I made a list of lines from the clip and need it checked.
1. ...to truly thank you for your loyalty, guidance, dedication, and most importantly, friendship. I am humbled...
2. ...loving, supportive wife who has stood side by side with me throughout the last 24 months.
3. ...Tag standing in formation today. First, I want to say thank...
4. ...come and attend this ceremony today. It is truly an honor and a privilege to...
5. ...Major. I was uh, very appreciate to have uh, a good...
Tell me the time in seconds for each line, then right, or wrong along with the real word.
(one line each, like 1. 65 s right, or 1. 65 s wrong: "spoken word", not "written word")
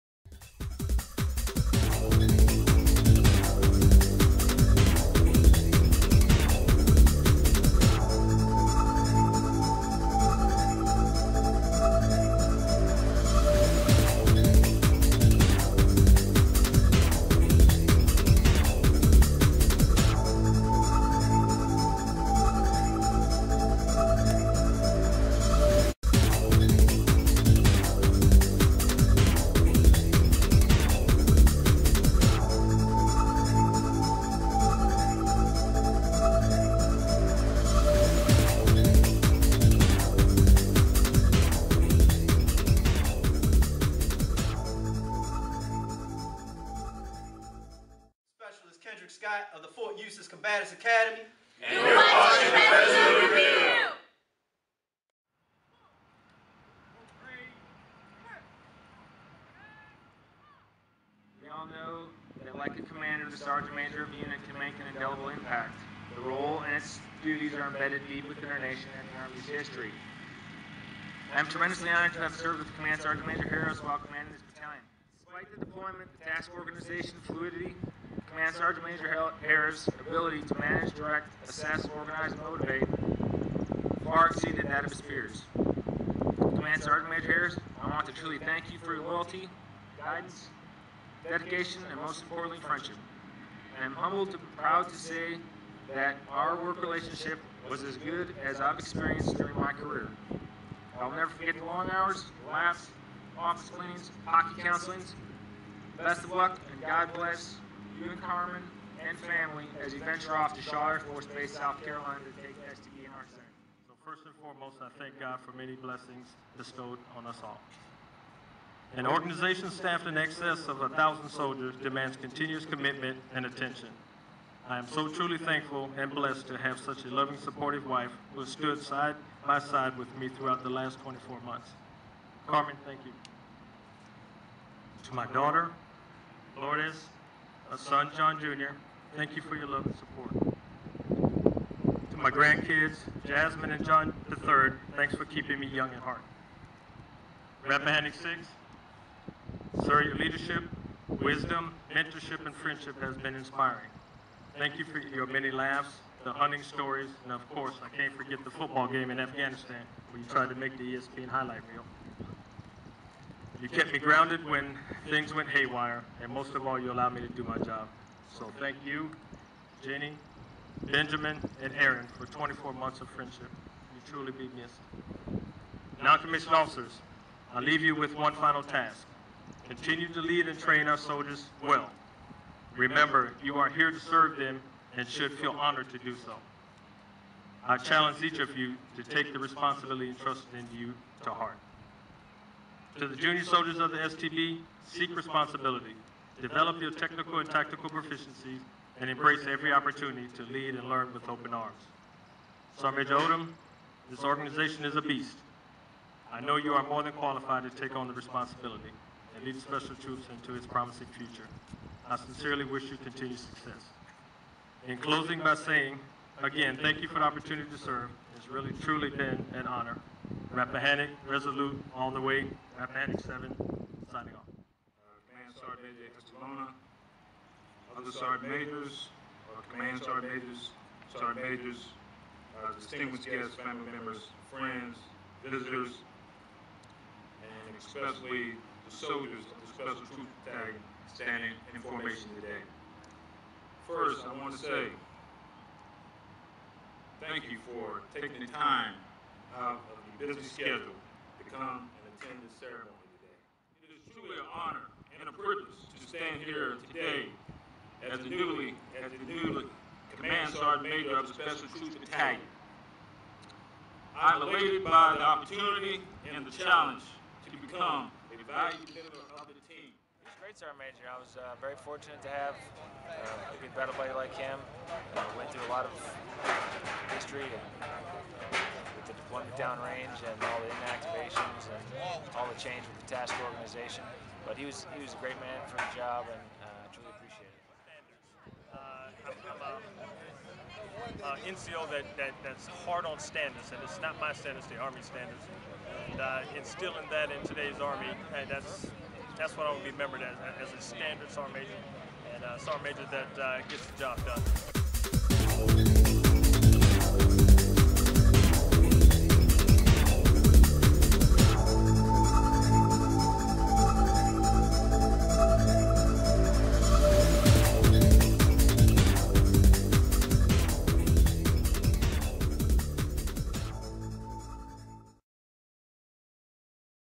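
1. 88 s right
2. 127 s right
3. 240 s right
4. 251 s right
5. 270 s wrong: "fortunate", not "appreciate".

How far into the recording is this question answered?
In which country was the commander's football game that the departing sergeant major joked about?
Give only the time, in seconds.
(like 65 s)
159 s.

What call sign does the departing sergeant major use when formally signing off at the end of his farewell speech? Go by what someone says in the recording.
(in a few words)
Rappahannock 7.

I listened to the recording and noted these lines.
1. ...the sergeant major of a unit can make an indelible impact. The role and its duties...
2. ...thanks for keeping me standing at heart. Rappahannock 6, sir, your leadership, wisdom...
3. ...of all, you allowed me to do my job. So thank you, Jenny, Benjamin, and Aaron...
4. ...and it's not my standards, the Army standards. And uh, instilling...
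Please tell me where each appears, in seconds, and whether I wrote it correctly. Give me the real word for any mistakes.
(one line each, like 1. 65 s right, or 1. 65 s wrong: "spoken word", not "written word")
1. 63 s right
2. 144 s wrong: "young", not "standing"
3. 166 s right
4. 293 s right.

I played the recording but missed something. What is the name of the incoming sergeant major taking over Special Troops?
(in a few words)
Odom.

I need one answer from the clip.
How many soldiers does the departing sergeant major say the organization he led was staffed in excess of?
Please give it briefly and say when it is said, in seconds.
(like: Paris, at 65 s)
1,000, at 120 s.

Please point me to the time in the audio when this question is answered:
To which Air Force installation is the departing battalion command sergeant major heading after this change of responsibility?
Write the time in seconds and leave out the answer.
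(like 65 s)
110 s.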